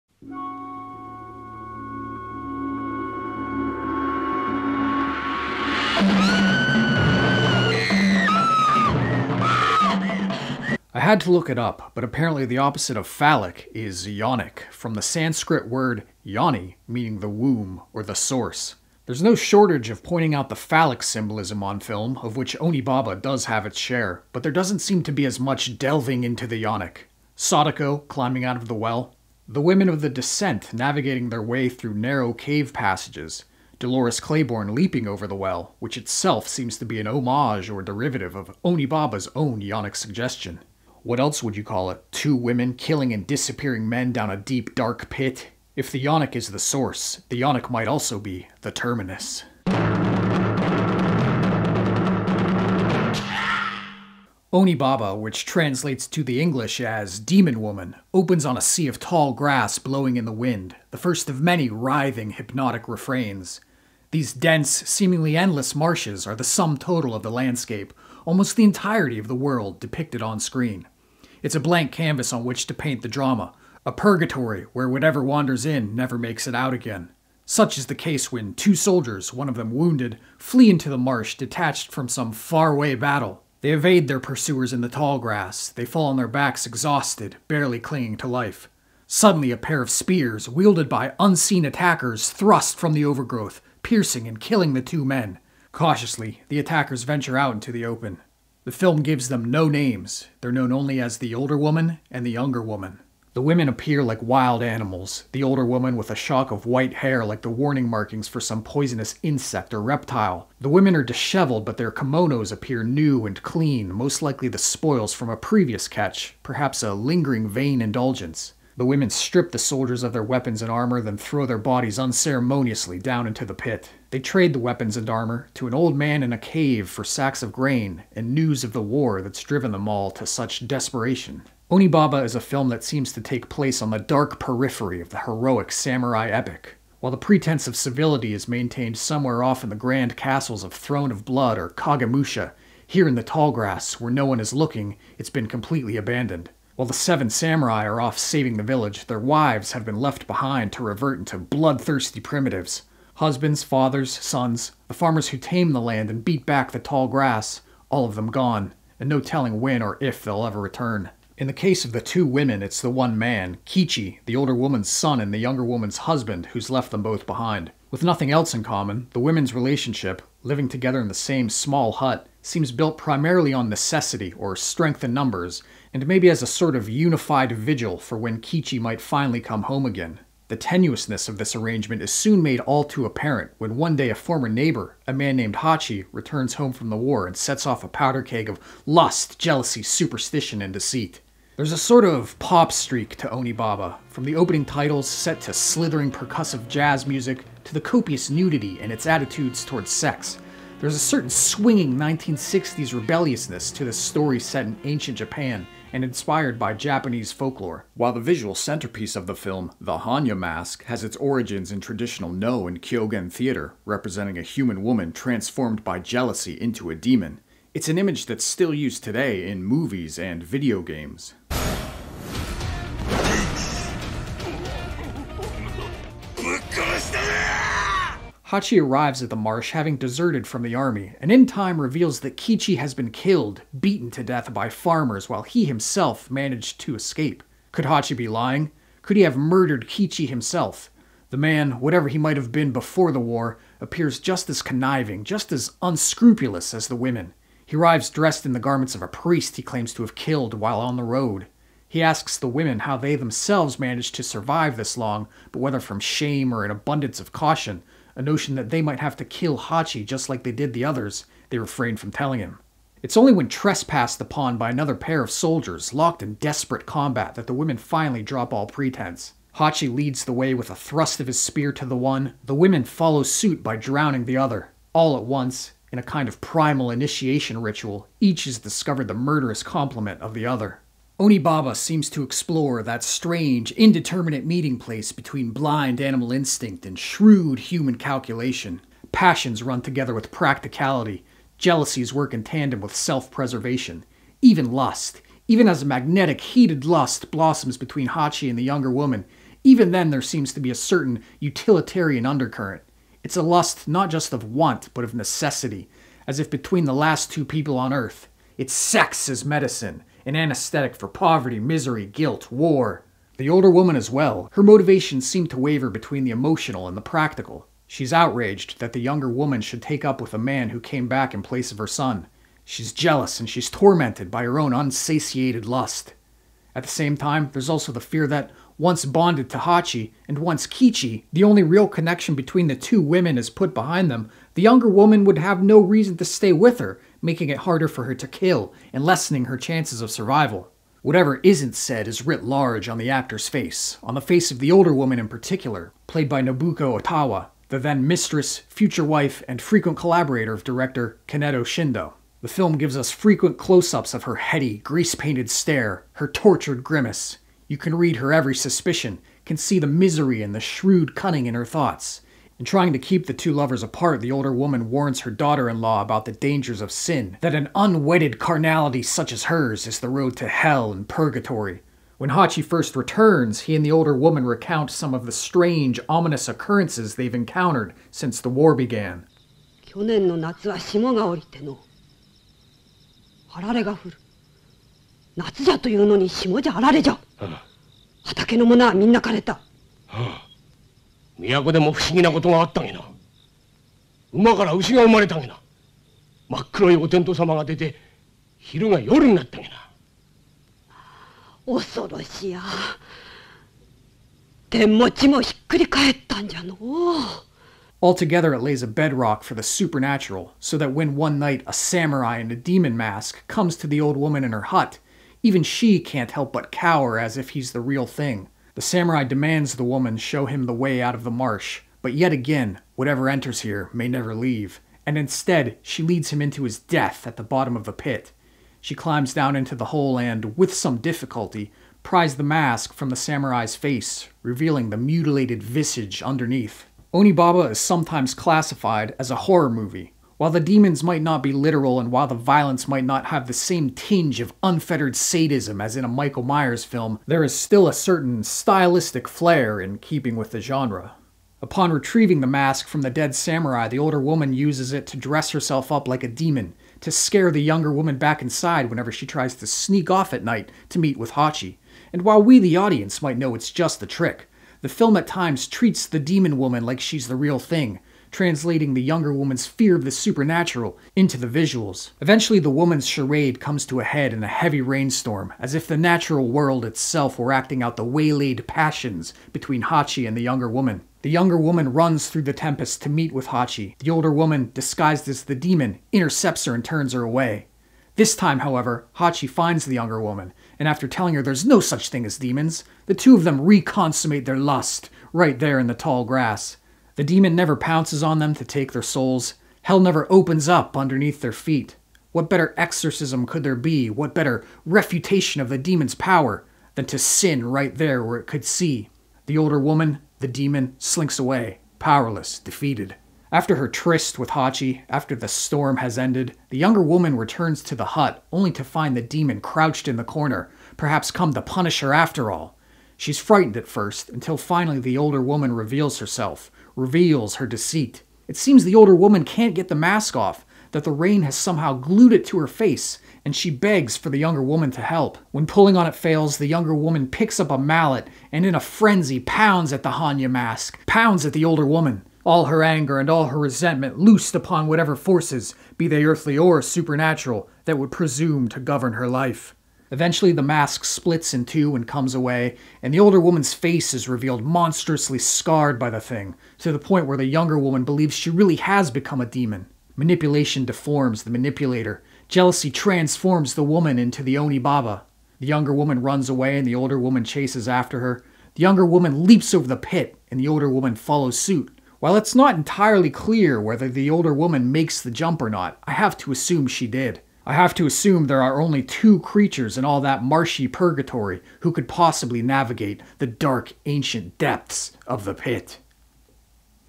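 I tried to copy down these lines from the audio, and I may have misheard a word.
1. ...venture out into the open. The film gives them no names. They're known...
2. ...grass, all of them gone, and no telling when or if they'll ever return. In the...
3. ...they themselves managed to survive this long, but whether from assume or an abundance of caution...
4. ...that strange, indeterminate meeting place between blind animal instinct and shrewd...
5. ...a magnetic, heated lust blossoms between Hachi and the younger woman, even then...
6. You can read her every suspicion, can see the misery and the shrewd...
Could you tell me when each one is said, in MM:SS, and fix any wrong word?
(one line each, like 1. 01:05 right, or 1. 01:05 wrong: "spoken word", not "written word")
1. 01:37 right
2. 02:37 right
3. 04:12 wrong: "shame", not "assume"
4. 04:42 right
5. 04:55 right
6. 05:57 right.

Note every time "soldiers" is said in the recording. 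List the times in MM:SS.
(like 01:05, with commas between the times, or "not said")
01:18, 01:59, 04:25.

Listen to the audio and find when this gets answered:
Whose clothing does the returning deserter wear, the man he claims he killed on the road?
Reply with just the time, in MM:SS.
04:09.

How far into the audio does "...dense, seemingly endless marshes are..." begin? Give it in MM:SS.
01:04.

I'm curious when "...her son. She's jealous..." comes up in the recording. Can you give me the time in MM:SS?
05:21.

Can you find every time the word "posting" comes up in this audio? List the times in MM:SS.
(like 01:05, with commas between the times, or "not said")
not said.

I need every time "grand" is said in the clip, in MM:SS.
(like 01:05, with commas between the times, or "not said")
02:19.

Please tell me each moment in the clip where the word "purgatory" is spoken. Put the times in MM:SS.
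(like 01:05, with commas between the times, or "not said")
01:13, 06:11, 09:40.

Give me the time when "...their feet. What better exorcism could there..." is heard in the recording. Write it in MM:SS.
08:21.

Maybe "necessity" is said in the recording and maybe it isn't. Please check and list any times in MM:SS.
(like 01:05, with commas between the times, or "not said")
02:53, 05:05.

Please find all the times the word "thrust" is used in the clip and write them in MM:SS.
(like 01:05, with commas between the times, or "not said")
01:32, 04:30.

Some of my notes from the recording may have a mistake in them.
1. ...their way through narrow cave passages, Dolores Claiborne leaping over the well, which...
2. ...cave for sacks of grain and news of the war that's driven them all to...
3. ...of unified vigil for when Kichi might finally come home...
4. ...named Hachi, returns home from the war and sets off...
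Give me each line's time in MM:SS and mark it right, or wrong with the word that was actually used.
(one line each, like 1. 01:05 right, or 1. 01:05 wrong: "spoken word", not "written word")
1. 00:31 right
2. 02:06 right
3. 02:56 right
4. 03:05 right.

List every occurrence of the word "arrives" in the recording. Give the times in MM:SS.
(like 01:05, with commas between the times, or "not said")
03:48, 04:07.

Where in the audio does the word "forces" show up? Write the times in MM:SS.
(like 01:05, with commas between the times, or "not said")
09:05.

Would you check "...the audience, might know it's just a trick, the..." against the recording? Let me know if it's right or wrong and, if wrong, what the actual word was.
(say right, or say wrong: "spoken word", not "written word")
right.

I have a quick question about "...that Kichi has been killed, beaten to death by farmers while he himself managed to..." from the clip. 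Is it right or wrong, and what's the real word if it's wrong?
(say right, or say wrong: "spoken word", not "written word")
right.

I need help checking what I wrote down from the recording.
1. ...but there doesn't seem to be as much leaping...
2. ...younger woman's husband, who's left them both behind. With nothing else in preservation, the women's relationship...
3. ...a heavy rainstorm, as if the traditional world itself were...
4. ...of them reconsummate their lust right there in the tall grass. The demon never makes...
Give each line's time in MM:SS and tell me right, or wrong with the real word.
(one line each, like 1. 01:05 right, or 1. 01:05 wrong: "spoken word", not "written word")
1. 00:24 wrong: "delving", not "leaping"
2. 02:45 wrong: "common", not "preservation"
3. 07:54 wrong: "natural", not "traditional"
4. 08:13 wrong: "pounces", not "makes".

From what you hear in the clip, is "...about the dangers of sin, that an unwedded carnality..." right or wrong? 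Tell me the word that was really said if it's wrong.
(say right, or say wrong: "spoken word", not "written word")
right.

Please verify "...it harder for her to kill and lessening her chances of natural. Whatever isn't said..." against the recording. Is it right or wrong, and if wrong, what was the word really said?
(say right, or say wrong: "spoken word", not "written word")
wrong: "survival", not "natural".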